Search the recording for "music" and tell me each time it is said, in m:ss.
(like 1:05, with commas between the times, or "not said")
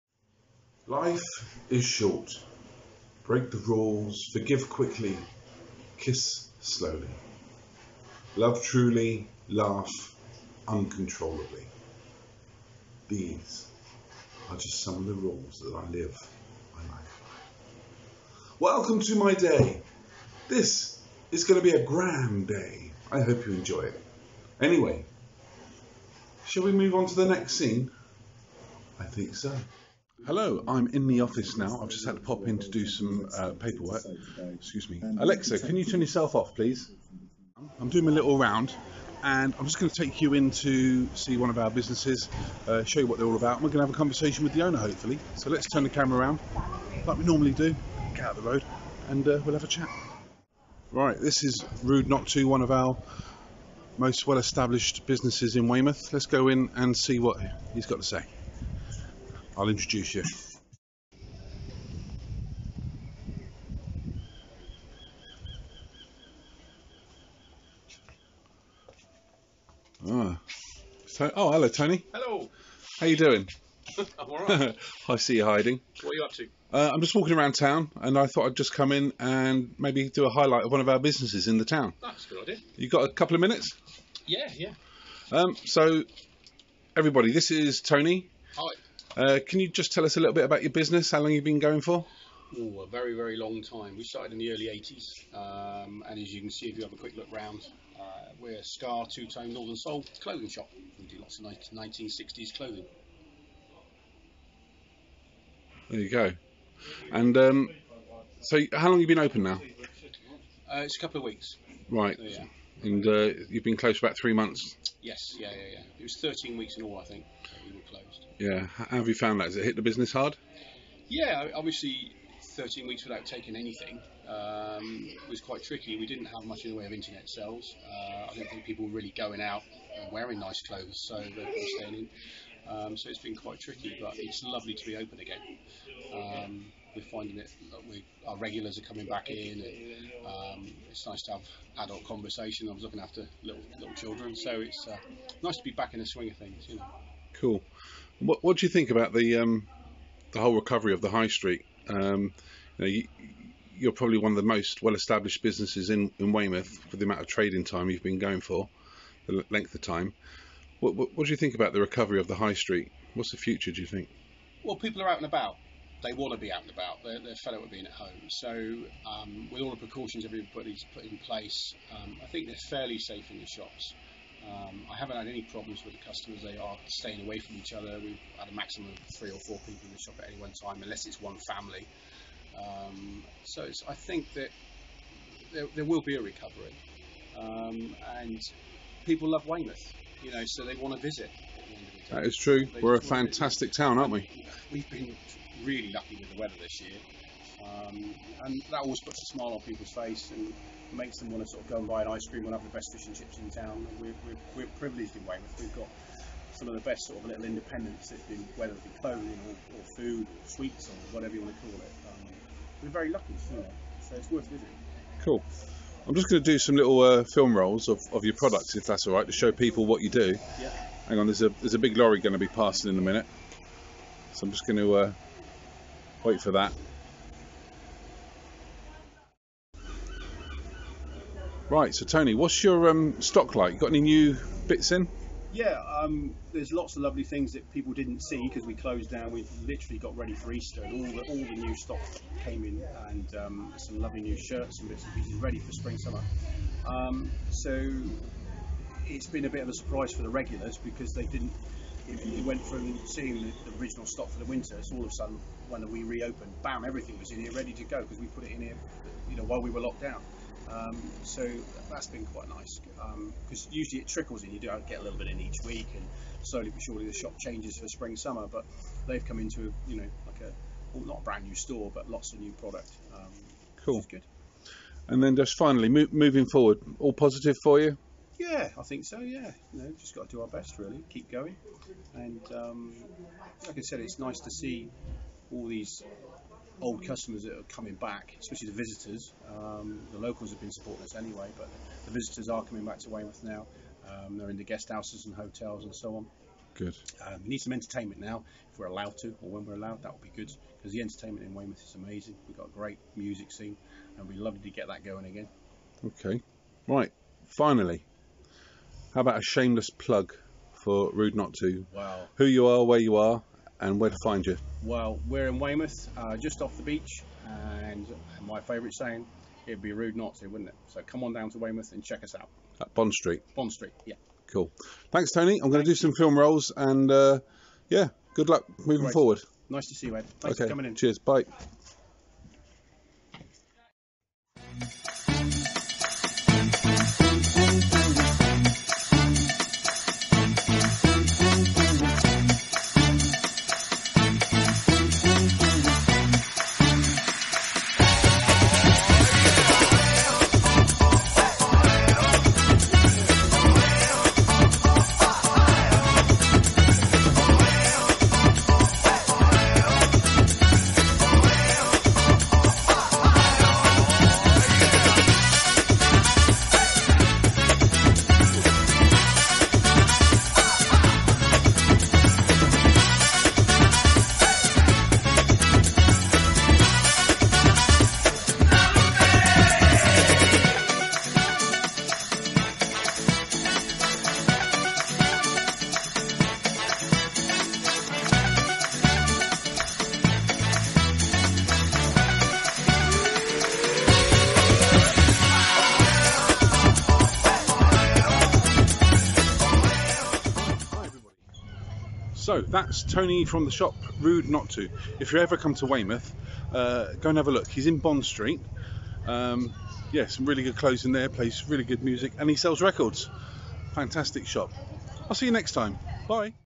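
5:03, 6:52.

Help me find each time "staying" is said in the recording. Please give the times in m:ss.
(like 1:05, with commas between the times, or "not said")
2:11, 2:56.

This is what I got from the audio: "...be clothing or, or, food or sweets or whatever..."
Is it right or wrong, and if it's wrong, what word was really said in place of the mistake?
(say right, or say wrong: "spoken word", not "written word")
right.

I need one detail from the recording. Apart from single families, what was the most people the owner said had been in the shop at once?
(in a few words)
three or four.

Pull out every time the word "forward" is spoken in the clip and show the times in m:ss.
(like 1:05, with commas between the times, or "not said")
4:36, 5:29.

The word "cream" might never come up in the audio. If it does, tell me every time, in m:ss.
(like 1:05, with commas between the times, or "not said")
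3:22.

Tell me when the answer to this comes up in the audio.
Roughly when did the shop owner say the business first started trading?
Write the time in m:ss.
1:34.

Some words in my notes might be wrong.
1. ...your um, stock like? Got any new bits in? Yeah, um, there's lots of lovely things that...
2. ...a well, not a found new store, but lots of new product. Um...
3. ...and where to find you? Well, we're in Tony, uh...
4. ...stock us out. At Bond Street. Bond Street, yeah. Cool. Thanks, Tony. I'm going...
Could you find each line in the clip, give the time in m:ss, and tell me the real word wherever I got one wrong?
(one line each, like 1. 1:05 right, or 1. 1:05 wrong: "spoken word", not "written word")
1. 3:52 right
2. 4:30 wrong: "brand", not "found"
3. 5:13 wrong: "Weymouth", not "Tony"
4. 5:22 wrong: "check", not "stock".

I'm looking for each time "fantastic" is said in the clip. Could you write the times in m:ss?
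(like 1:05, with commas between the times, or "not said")
3:13, 6:53.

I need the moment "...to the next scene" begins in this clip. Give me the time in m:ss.
0:27.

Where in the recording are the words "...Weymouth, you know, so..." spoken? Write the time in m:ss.
3:09.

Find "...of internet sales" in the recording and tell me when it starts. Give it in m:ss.
2:06.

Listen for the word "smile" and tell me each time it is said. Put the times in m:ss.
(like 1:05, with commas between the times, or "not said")
3:19.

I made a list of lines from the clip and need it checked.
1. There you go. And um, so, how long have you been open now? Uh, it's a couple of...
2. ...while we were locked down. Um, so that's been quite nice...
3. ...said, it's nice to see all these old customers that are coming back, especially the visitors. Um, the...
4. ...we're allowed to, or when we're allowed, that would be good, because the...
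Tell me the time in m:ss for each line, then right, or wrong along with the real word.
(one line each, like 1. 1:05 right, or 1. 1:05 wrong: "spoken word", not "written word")
1. 1:45 right
2. 4:19 right
3. 4:43 right
4. 4:58 right.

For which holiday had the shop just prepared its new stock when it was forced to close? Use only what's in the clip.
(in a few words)
Easter.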